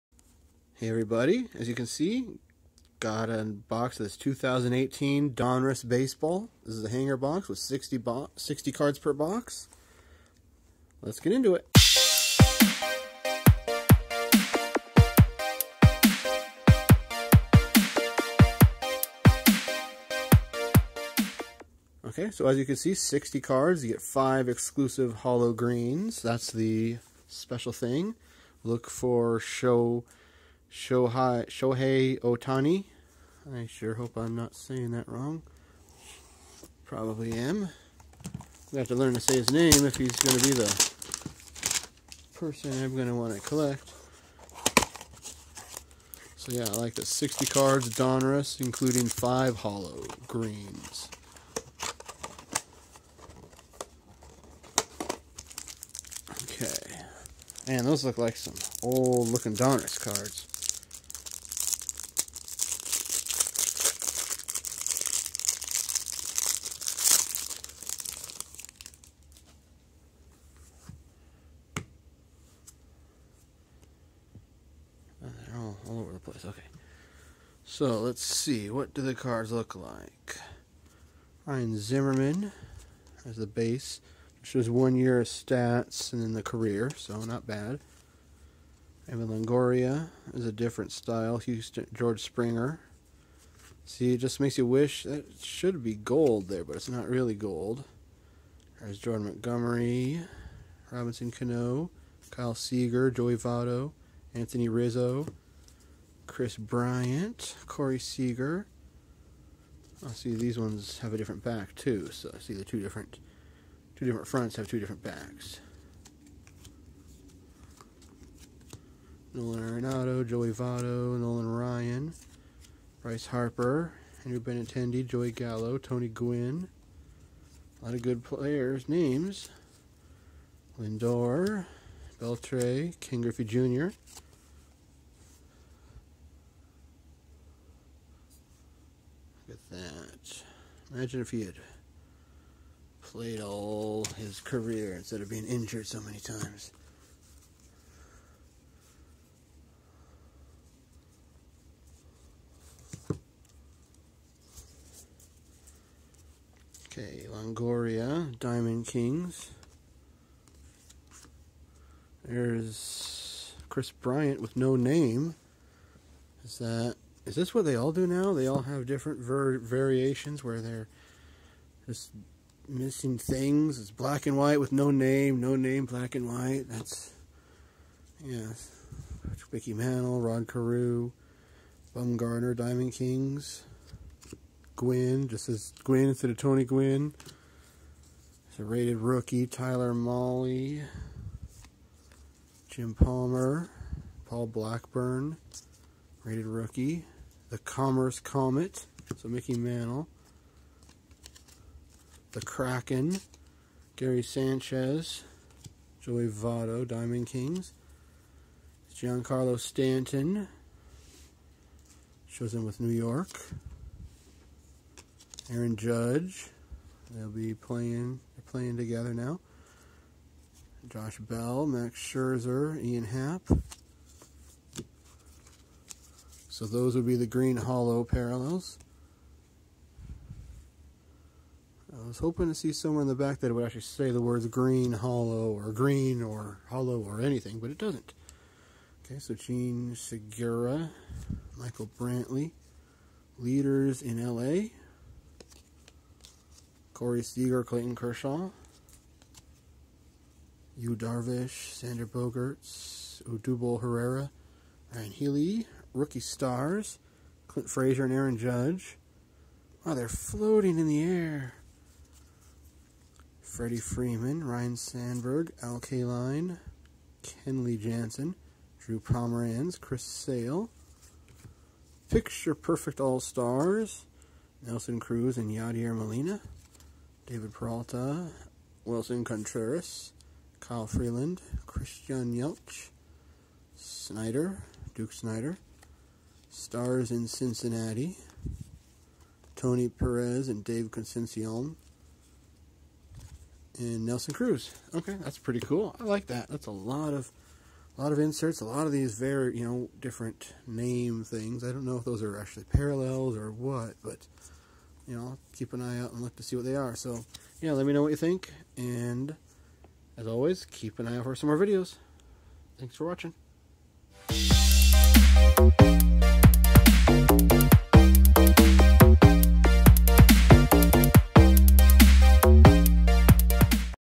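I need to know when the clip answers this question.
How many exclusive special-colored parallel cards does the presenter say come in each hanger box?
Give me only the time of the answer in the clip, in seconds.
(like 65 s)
24 s.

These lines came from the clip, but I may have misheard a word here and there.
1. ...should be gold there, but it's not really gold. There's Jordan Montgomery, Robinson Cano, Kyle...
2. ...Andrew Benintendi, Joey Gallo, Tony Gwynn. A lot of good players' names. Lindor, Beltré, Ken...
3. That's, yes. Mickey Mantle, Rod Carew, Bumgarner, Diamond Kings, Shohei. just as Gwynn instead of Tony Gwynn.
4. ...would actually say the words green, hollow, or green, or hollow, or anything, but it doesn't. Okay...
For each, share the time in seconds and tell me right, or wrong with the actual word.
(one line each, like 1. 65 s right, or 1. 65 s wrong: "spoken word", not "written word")
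1. 95 s right
2. 124 s right
3. 176 s wrong: "Gwynn", not "Shohei"
4. 233 s right.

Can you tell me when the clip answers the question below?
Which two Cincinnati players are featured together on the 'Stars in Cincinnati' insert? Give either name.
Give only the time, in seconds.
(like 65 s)
289 s.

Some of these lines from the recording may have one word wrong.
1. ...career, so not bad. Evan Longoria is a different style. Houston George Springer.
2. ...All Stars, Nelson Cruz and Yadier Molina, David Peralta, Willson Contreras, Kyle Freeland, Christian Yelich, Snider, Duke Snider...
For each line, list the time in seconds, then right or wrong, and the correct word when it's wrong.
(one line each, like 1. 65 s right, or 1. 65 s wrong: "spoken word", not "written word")
1. 86 s right
2. 272 s right.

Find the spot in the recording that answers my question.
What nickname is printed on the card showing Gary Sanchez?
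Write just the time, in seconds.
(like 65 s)
202 s.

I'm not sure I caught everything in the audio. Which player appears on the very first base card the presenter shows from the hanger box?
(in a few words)
Ryan Zimmerman.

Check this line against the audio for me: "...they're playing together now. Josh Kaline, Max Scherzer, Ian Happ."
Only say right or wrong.
wrong.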